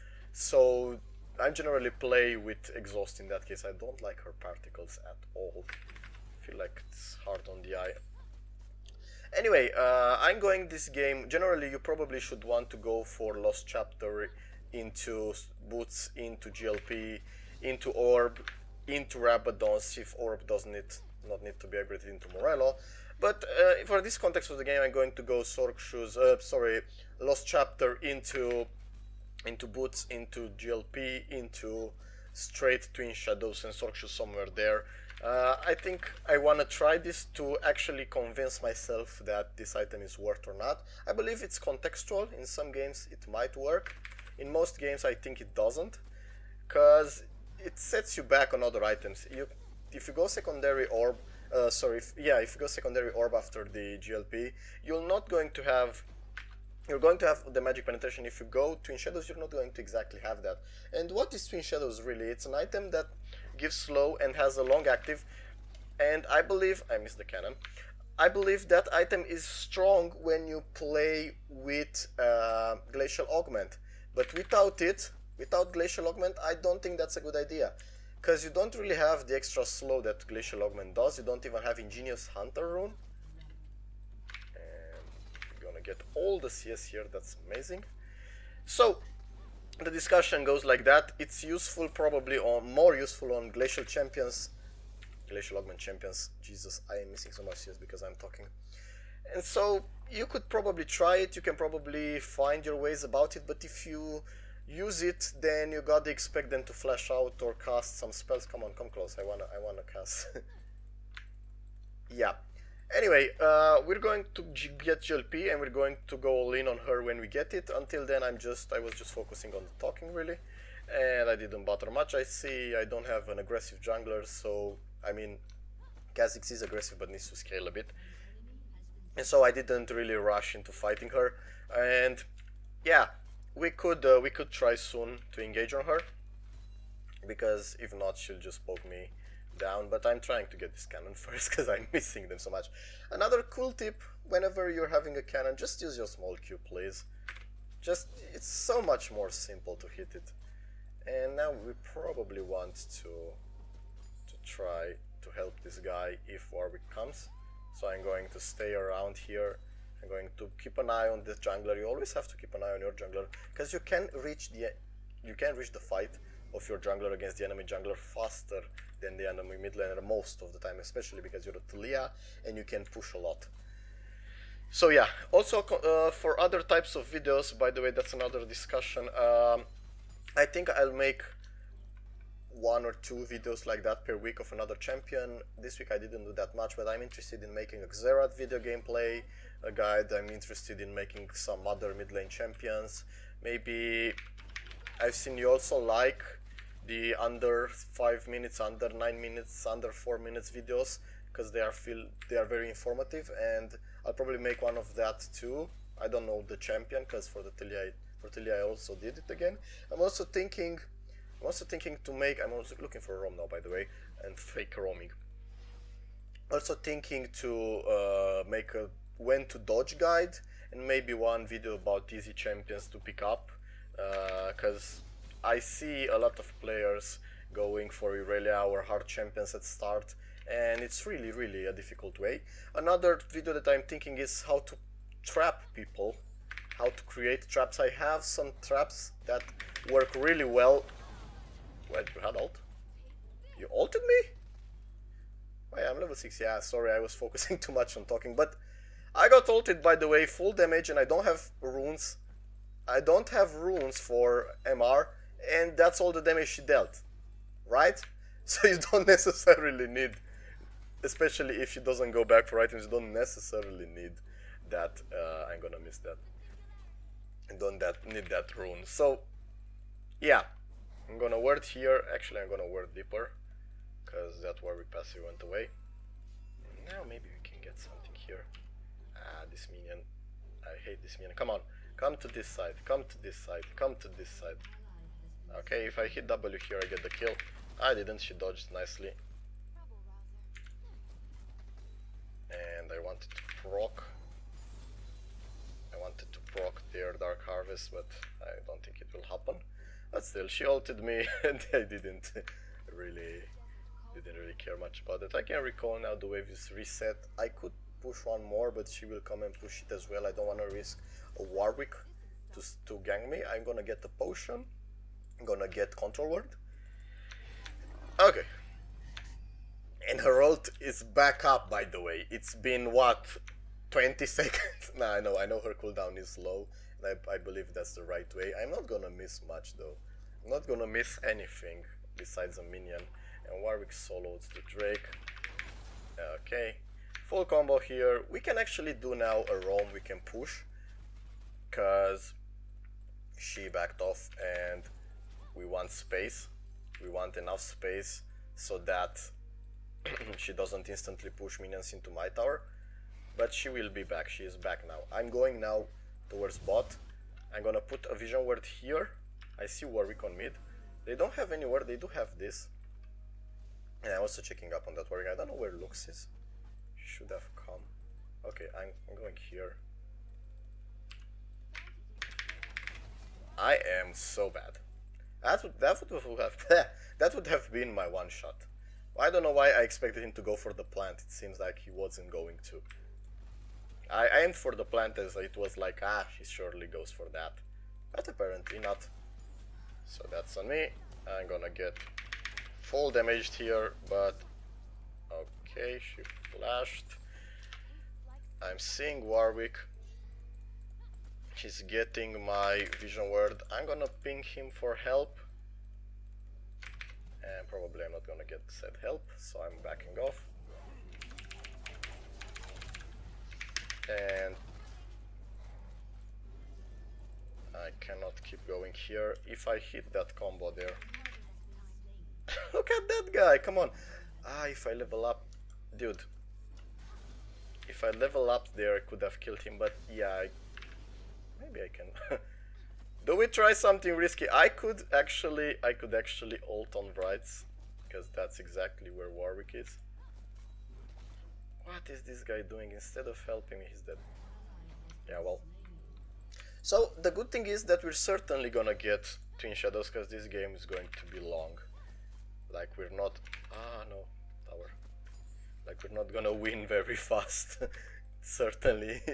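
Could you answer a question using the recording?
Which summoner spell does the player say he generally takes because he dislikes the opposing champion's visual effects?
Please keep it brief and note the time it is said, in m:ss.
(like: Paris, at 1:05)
Exhaust, at 0:02.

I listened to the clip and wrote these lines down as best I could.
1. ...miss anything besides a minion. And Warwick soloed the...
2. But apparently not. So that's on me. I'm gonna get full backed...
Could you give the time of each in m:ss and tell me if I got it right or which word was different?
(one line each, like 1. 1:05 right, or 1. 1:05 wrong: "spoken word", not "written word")
1. 5:30 right
2. 6:28 wrong: "damaged", not "backed".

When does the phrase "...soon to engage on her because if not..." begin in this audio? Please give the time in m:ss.
2:14.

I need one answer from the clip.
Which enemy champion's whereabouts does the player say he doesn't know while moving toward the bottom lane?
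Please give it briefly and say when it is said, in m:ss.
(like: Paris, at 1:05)
Lux, at 6:05.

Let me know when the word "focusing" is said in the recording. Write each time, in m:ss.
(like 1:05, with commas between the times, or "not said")
1:59, 4:07.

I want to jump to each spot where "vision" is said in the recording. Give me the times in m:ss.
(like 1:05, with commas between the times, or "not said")
5:58, 6:43.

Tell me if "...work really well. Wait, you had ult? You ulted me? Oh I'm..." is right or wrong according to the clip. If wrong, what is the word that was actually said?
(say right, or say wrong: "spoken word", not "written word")
right.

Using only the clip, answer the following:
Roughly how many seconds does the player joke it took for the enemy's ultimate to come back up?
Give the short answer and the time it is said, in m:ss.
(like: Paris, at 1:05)
20, at 5:23.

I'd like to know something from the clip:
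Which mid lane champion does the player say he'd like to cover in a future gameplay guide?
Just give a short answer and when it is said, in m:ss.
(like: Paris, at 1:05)
Xerath, at 3:07.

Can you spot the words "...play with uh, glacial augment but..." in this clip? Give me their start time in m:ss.
1:10.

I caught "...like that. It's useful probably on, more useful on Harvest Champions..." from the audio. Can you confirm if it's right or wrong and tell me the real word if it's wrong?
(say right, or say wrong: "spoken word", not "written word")
wrong: "Glacial", not "Harvest".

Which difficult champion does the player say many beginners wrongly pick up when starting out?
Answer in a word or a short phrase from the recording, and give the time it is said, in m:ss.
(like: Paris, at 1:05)
Irelia, at 3:48.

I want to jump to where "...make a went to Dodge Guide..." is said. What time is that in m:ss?
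3:38.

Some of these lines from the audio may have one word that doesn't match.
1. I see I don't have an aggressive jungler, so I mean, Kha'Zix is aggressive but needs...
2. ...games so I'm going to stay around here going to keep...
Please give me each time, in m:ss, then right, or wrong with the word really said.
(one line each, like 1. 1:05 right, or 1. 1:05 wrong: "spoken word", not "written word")
1. 2:02 right
2. 2:36 wrong: "comes", not "games".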